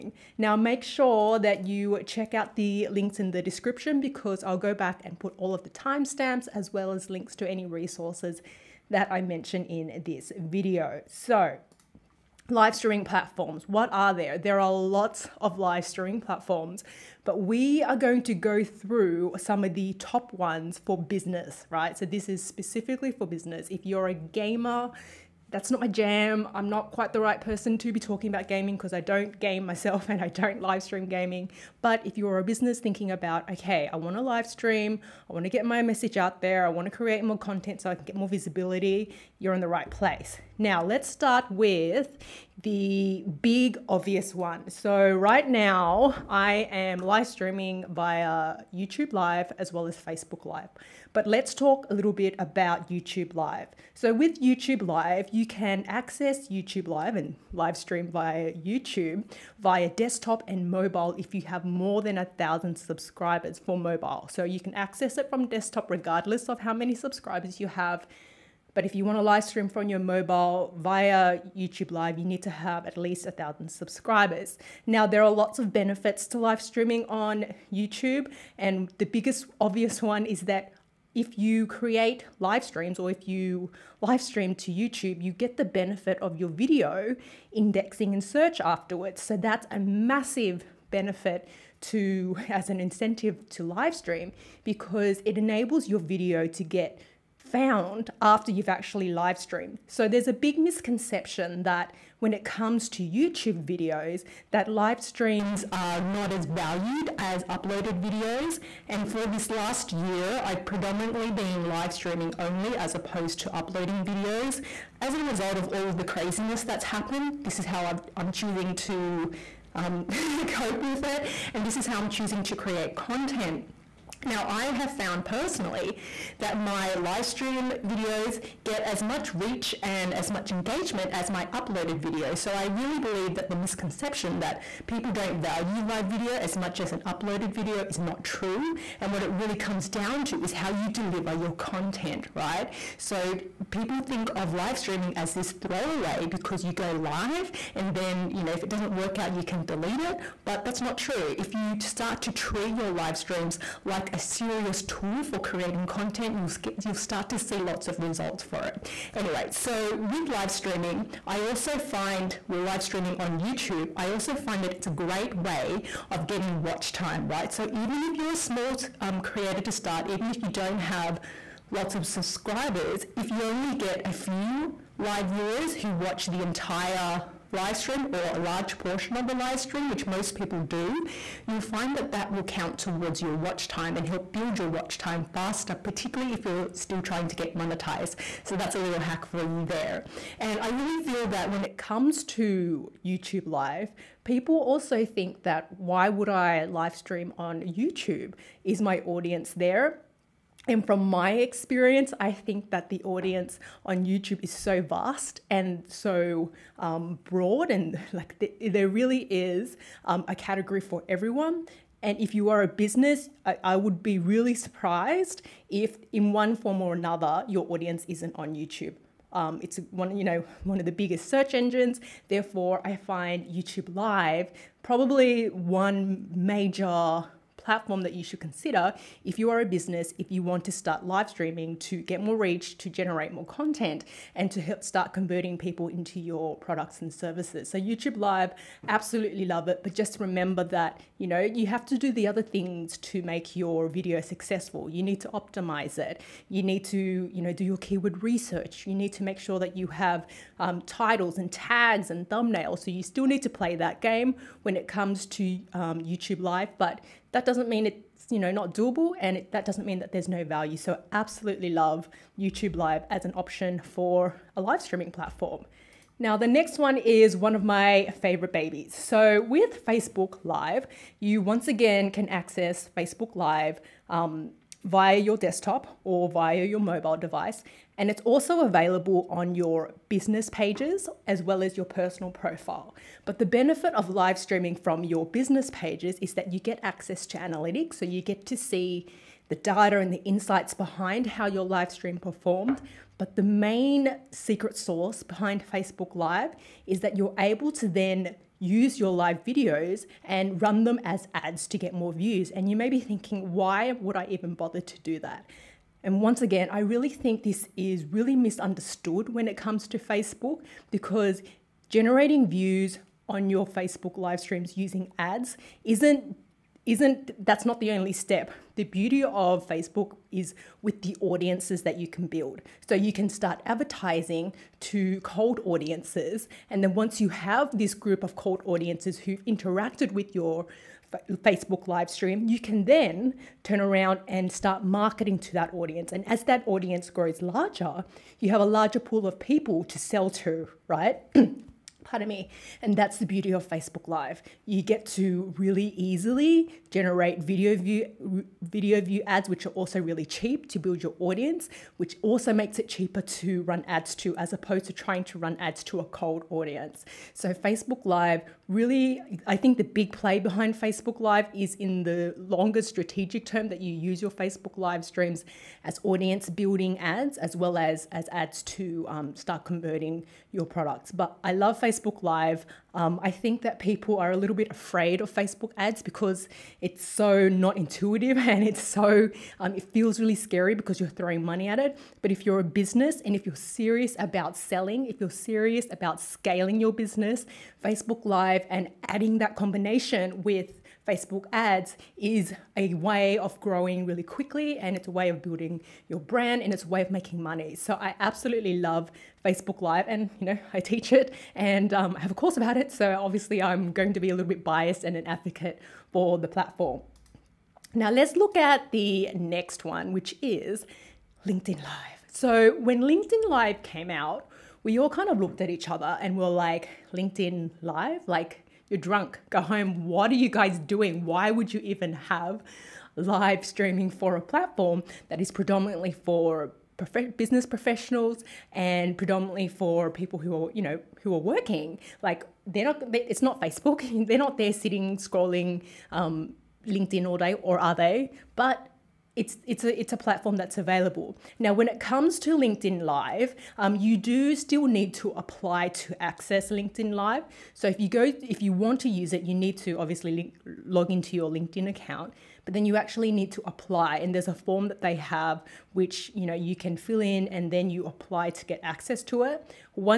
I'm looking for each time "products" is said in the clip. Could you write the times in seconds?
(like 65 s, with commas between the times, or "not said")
236 s, 370 s.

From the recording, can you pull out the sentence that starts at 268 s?
So, with Facebook Live, you once again can access Facebook Live um, via your desktop or via your mobile device.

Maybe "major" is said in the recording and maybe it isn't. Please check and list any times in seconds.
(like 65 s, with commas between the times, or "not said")
226 s.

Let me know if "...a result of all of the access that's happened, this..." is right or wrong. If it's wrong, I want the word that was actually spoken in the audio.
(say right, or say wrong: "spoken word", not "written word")
wrong: "craziness", not "access".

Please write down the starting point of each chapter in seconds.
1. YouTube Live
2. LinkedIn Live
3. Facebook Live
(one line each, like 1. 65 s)
1. 42 s
2. 407 s
3. 265 s.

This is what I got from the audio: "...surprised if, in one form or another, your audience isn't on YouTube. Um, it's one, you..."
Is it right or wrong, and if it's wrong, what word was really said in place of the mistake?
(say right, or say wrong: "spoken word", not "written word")
right.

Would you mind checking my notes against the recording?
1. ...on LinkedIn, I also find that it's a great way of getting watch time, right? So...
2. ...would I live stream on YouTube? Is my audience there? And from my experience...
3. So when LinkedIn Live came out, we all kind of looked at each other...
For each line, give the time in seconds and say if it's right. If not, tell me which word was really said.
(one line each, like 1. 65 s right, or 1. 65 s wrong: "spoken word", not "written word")
1. 163 s wrong: "YouTube", not "LinkedIn"
2. 196 s right
3. 412 s right.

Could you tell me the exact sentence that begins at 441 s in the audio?
Now, when it comes to LinkedIn Live, um, you do still need to apply to access LinkedIn Live.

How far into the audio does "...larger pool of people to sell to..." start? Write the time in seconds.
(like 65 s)
338 s.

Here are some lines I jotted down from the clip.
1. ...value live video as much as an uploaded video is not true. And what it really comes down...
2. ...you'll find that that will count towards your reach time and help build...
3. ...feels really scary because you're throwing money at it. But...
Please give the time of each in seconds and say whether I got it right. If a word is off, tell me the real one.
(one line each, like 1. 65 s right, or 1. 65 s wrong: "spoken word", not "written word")
1. 135 s right
2. 181 s wrong: "watch", not "reach"
3. 379 s right.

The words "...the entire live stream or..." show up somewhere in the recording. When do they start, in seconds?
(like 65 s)
176 s.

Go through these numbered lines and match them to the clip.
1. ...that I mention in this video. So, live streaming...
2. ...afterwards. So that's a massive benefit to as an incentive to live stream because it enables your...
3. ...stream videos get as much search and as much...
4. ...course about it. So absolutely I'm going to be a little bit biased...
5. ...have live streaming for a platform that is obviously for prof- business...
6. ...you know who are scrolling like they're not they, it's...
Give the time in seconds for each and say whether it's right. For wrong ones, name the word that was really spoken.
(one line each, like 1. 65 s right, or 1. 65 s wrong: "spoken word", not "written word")
1. 8 s right
2. 88 s right
3. 127 s wrong: "reach", not "search"
4. 402 s wrong: "obviously", not "absolutely"
5. 422 s wrong: "predominantly", not "obviously"
6. 430 s wrong: "working", not "scrolling".